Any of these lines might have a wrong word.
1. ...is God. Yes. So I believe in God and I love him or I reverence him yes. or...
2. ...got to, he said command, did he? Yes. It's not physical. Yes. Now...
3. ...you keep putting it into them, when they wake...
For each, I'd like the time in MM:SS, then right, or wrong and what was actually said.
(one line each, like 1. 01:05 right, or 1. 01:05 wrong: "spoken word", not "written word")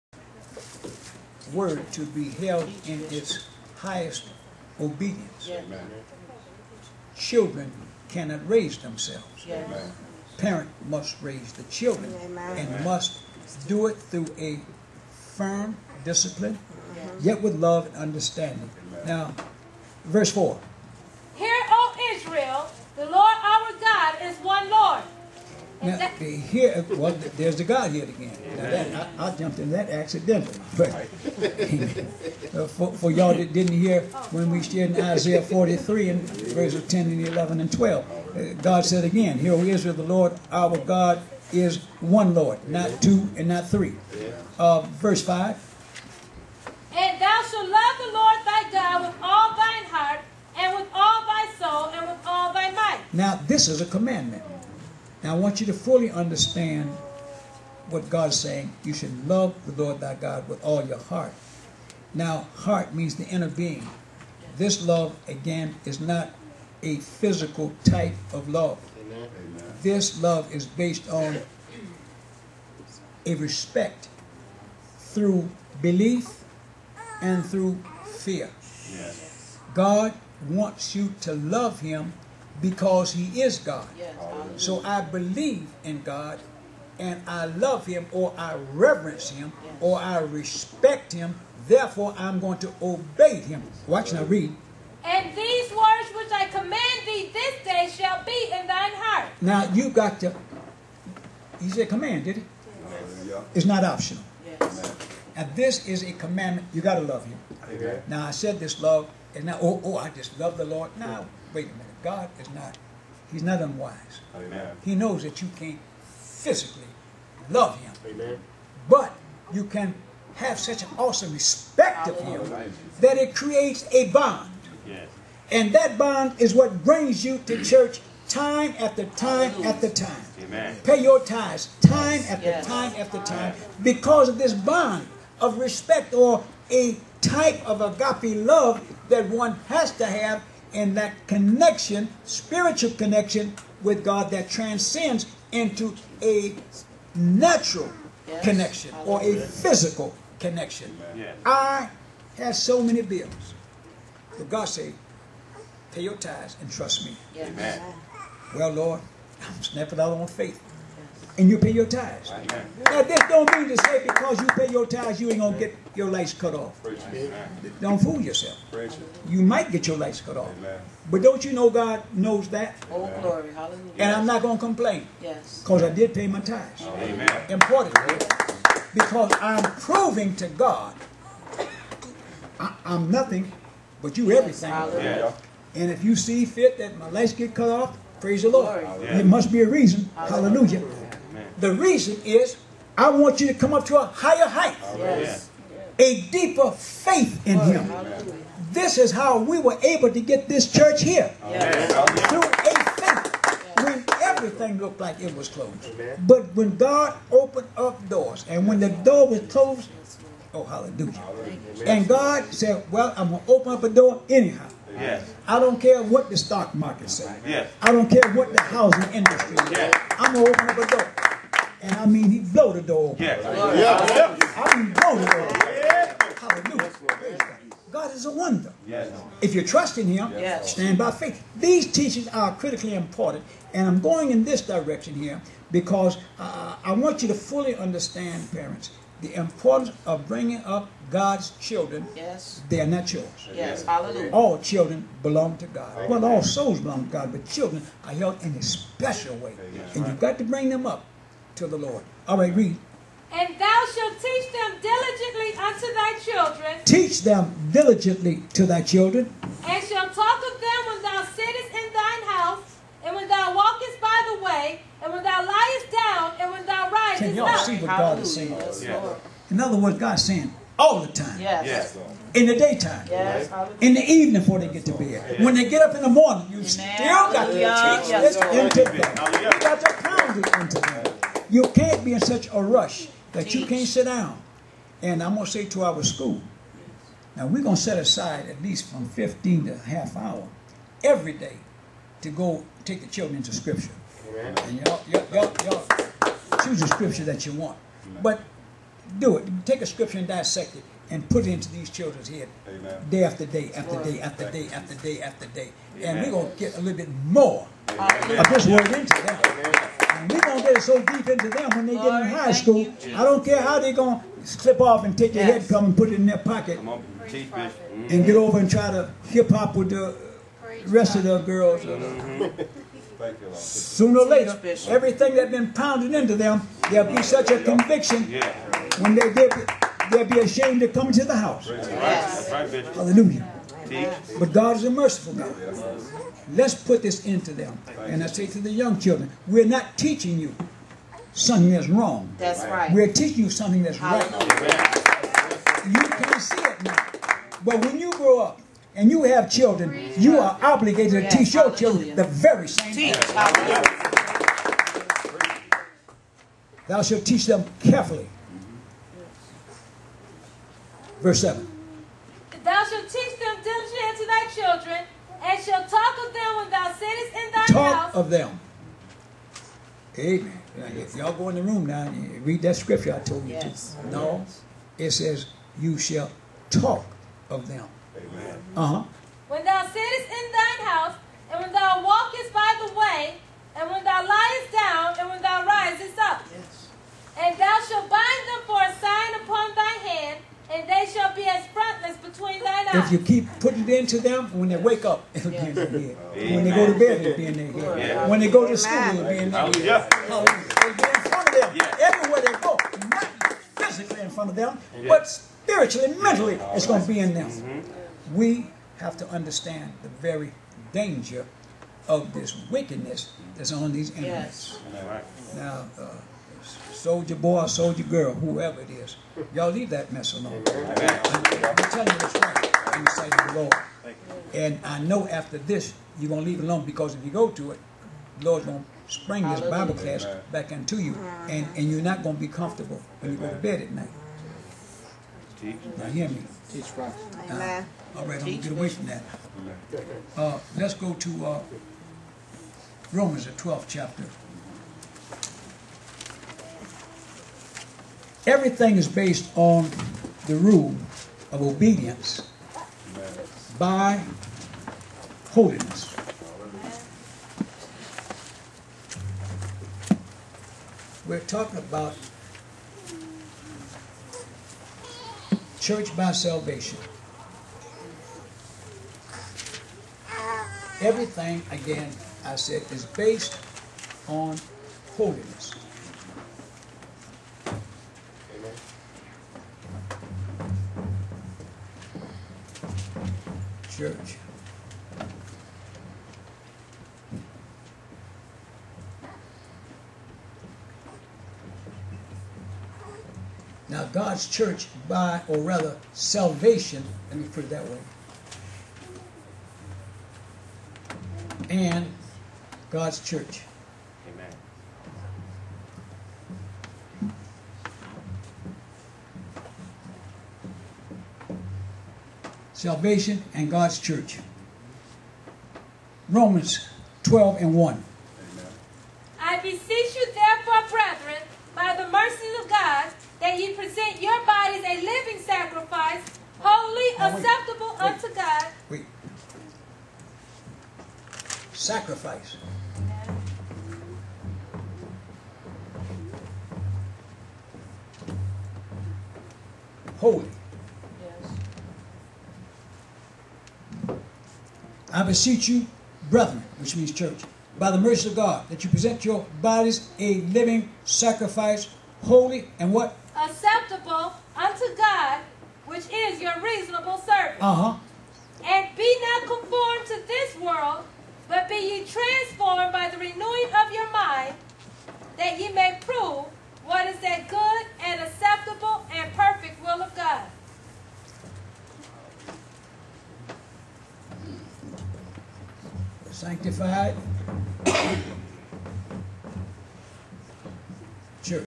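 1. 01:23 right
2. 01:39 wrong: "optional", not "physical"
3. 06:33 right.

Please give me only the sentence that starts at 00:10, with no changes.
Parent must raise the children Amen.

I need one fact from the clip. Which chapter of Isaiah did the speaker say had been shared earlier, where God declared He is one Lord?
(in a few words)
Isaiah 43.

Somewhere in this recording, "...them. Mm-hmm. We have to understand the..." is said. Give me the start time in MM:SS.
06:47.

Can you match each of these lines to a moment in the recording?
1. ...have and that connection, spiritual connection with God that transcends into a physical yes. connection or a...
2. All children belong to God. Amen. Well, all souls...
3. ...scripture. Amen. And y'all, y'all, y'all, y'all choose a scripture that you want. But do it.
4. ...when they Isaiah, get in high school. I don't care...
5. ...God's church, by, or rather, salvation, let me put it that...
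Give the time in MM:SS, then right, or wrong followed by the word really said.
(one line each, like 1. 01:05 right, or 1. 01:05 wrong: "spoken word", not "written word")
1. 02:20 wrong: "natural", not "physical"
2. 04:04 right
3. 04:53 right
4. 05:11 wrong: "Lord", not "Isaiah"
5. 08:14 right.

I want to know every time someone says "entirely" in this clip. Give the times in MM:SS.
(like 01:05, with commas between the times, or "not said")
not said.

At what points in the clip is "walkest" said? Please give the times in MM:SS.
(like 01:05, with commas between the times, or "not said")
04:23, 06:22.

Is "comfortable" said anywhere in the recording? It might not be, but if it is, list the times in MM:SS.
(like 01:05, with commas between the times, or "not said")
07:12.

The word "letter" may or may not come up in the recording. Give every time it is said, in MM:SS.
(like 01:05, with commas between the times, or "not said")
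not said.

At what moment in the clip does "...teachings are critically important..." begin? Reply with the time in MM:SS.
03:51.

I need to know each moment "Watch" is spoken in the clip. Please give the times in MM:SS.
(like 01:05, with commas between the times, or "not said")
01:33.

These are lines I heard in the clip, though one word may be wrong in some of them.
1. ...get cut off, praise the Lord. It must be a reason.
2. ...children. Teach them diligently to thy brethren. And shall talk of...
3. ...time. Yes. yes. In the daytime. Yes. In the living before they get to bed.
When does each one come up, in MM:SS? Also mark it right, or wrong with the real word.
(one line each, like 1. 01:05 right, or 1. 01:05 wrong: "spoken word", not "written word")
1. 03:07 right
2. 04:16 wrong: "children", not "brethren"
3. 04:31 wrong: "evening", not "living".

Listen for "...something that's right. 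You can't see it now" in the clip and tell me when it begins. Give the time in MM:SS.
05:43.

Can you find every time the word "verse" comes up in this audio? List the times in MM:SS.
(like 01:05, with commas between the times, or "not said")
00:20, 00:36, 00:44, 06:01.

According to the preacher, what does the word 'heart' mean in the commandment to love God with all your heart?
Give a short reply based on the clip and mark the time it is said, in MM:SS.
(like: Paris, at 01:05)
The inner being, at 01:03.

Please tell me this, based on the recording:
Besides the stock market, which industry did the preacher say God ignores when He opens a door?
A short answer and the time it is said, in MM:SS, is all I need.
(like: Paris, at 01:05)
Housing industry, at 03:38.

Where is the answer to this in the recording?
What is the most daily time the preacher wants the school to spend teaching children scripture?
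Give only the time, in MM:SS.
04:49.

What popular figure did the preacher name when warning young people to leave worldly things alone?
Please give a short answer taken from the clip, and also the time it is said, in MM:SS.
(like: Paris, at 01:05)
Soulja Boy, at 06:57.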